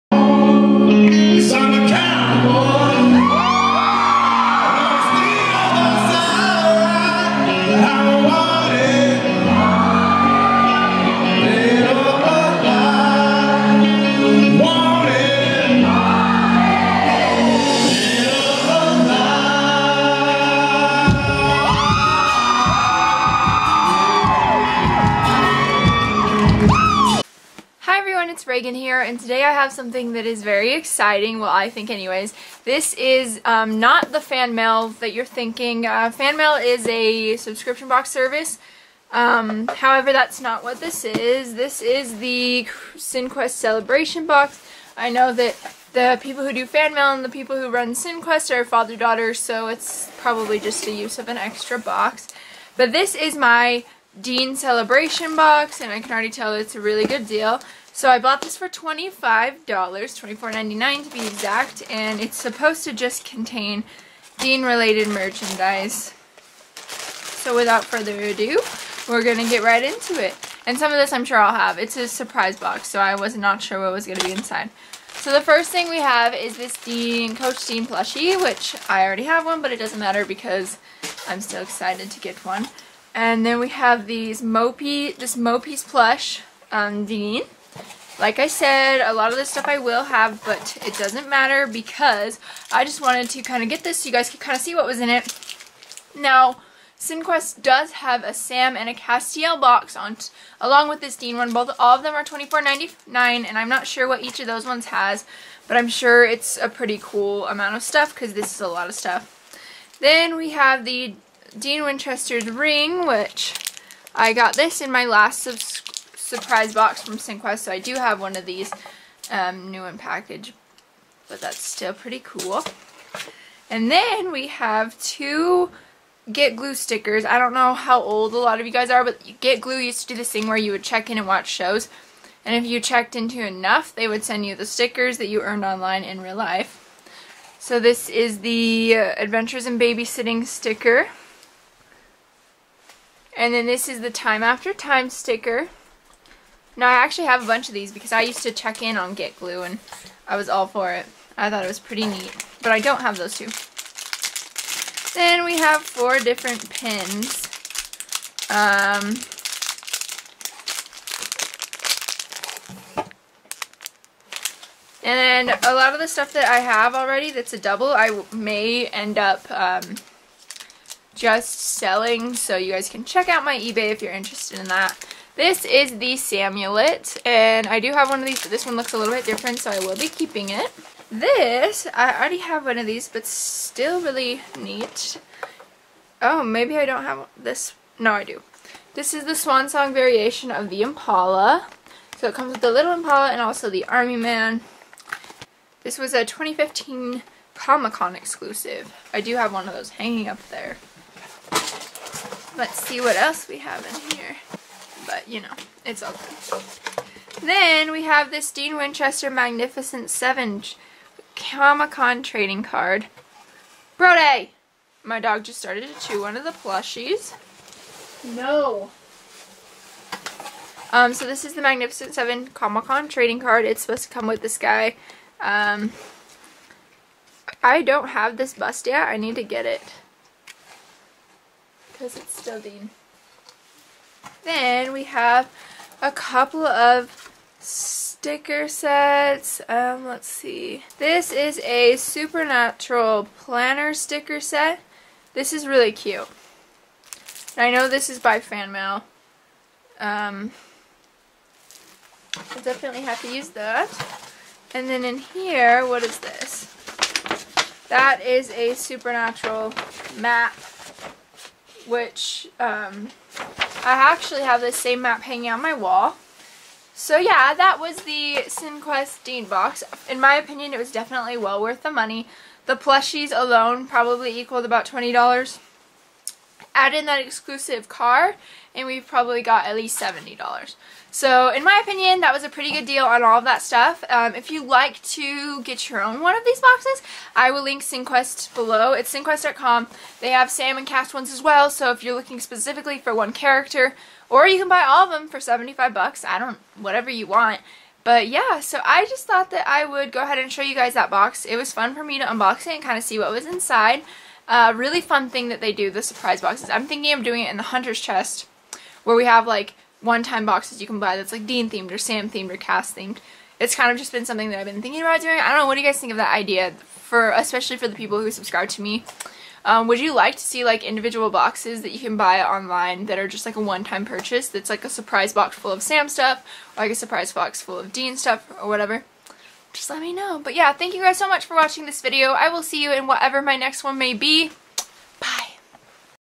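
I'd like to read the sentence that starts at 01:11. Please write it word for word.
It's a surprise box, so I was not sure what was going to be inside.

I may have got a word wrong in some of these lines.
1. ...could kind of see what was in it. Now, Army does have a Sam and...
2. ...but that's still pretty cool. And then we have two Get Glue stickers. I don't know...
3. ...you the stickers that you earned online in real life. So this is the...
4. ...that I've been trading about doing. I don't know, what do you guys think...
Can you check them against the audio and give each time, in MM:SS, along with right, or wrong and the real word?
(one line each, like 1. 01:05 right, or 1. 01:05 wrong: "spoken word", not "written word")
1. 01:34 wrong: "Cinequest", not "Army"
2. 02:01 right
3. 02:14 right
4. 05:14 wrong: "thinking", not "trading".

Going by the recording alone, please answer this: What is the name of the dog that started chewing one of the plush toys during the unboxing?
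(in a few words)
Brode.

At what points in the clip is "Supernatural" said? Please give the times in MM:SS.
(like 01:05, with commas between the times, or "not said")
04:01, 04:18.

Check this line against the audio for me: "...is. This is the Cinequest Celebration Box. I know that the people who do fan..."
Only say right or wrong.
right.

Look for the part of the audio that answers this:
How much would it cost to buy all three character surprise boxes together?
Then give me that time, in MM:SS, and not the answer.
04:55.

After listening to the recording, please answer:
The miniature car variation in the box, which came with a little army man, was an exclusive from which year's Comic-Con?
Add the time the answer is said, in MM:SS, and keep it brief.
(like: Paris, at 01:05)
2015, at 03:16.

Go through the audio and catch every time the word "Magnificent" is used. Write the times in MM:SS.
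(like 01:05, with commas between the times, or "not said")
03:29, 03:41.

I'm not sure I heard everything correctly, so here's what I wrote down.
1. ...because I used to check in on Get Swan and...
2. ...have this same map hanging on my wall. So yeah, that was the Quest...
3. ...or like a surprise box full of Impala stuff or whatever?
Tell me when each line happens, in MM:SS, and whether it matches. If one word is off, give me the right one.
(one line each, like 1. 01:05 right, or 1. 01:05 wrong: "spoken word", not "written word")
1. 02:27 wrong: "Glue", not "Swan"
2. 04:24 right
3. 05:26 wrong: "Dean", not "Impala".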